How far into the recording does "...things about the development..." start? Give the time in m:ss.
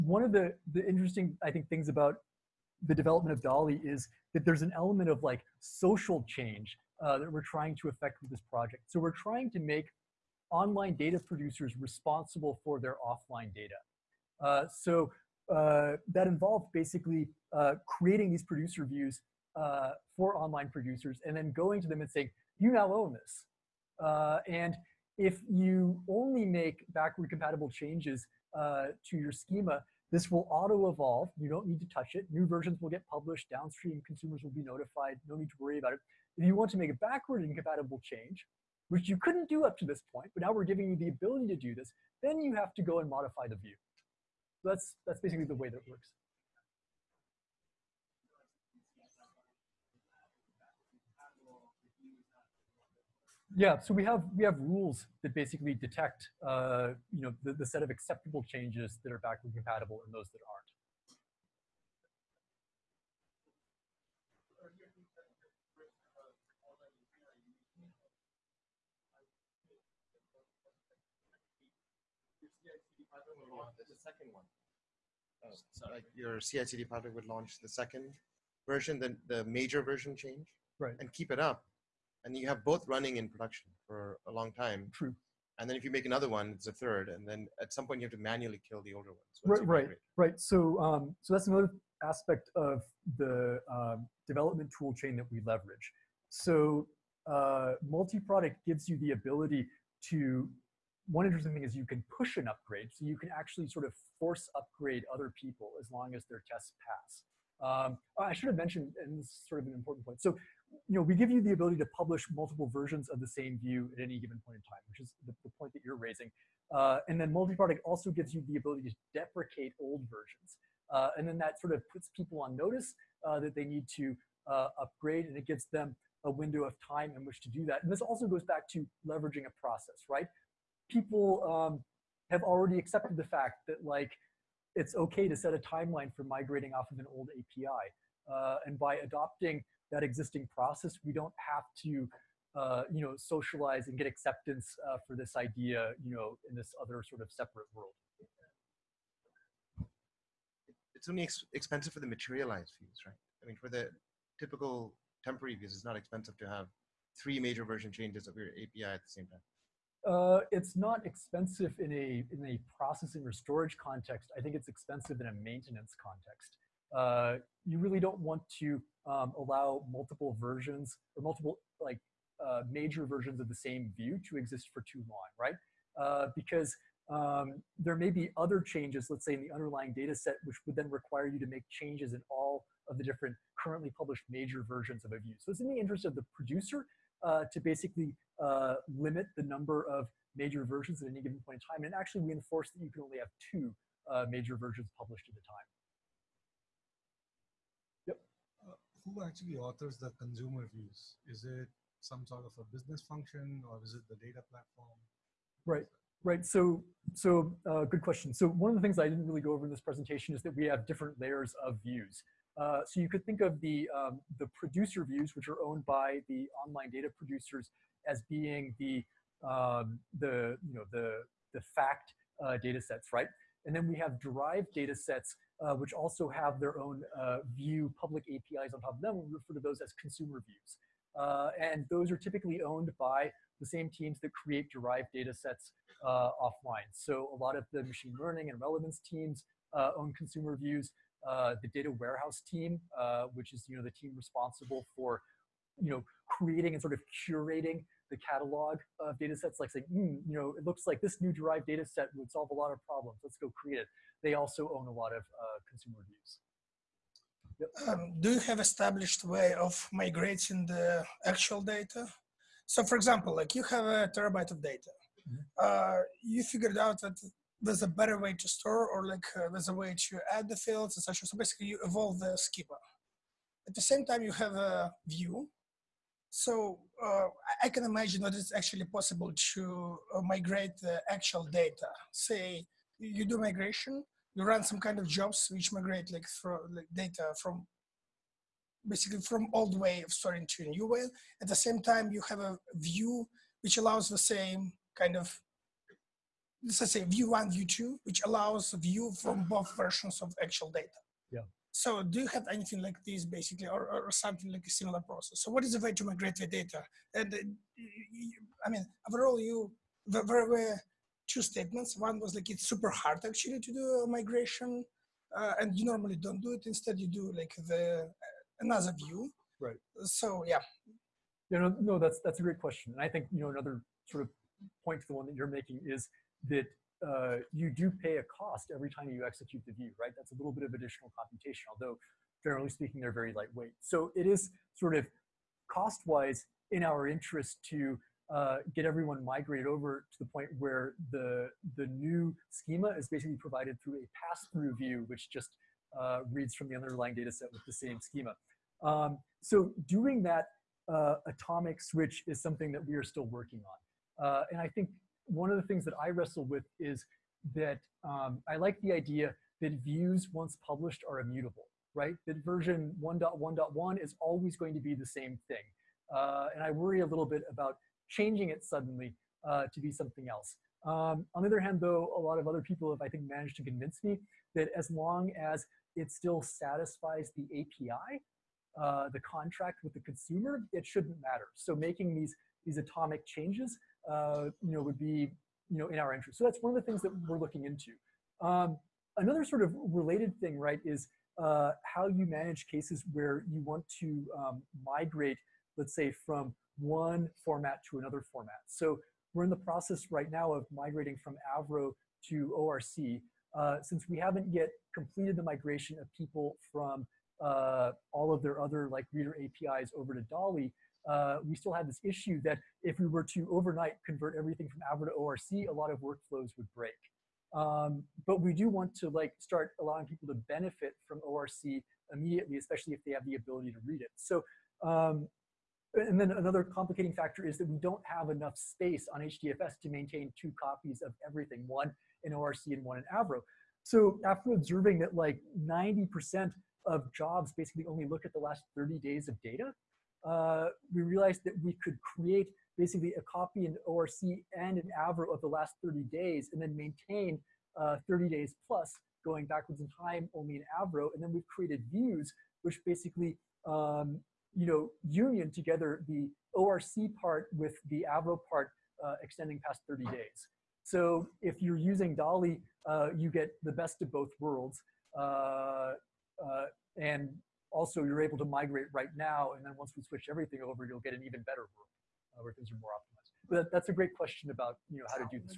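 0:01.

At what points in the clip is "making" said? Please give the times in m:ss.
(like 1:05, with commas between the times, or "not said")
5:25, 6:21.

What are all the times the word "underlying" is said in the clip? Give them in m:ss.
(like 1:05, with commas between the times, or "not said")
2:59, 5:46.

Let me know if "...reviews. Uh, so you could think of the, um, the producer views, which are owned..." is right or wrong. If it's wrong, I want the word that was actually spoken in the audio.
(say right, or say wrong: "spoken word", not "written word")
wrong: "views", not "reviews".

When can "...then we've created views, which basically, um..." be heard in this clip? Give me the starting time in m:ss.
7:31.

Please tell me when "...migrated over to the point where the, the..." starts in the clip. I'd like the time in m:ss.
5:39.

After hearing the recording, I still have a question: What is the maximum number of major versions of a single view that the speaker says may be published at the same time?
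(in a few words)
2.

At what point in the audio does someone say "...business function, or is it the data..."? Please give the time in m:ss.
3:22.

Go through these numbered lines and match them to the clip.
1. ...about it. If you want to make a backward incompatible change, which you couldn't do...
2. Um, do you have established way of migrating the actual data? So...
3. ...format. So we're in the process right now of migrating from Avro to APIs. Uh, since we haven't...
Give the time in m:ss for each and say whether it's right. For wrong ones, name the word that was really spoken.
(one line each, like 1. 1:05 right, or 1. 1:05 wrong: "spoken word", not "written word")
1. 0:35 right
2. 4:17 right
3. 6:38 wrong: "ORC", not "APIs".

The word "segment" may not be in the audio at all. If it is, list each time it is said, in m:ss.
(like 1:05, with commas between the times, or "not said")
not said.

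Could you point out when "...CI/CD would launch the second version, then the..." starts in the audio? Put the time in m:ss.
1:16.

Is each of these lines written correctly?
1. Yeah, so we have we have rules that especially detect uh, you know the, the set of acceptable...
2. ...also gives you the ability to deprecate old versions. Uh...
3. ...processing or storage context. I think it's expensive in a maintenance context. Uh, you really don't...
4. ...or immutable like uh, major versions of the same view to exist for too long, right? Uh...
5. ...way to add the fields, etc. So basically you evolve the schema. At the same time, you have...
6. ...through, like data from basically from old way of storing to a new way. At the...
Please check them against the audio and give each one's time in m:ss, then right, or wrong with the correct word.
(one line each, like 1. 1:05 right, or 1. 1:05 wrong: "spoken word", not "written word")
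1. 0:53 wrong: "basically", not "especially"
2. 1:57 right
3. 2:42 right
4. 2:51 wrong: "multiple", not "immutable"
5. 4:29 right
6. 4:46 right.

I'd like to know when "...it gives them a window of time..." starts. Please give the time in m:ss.
2:05.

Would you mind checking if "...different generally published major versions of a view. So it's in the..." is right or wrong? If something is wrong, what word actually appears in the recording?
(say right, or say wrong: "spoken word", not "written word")
wrong: "currently", not "generally".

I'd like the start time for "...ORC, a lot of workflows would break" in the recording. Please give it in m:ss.
6:55.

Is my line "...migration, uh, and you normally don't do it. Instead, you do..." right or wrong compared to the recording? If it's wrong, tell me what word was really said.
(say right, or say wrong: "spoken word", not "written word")
right.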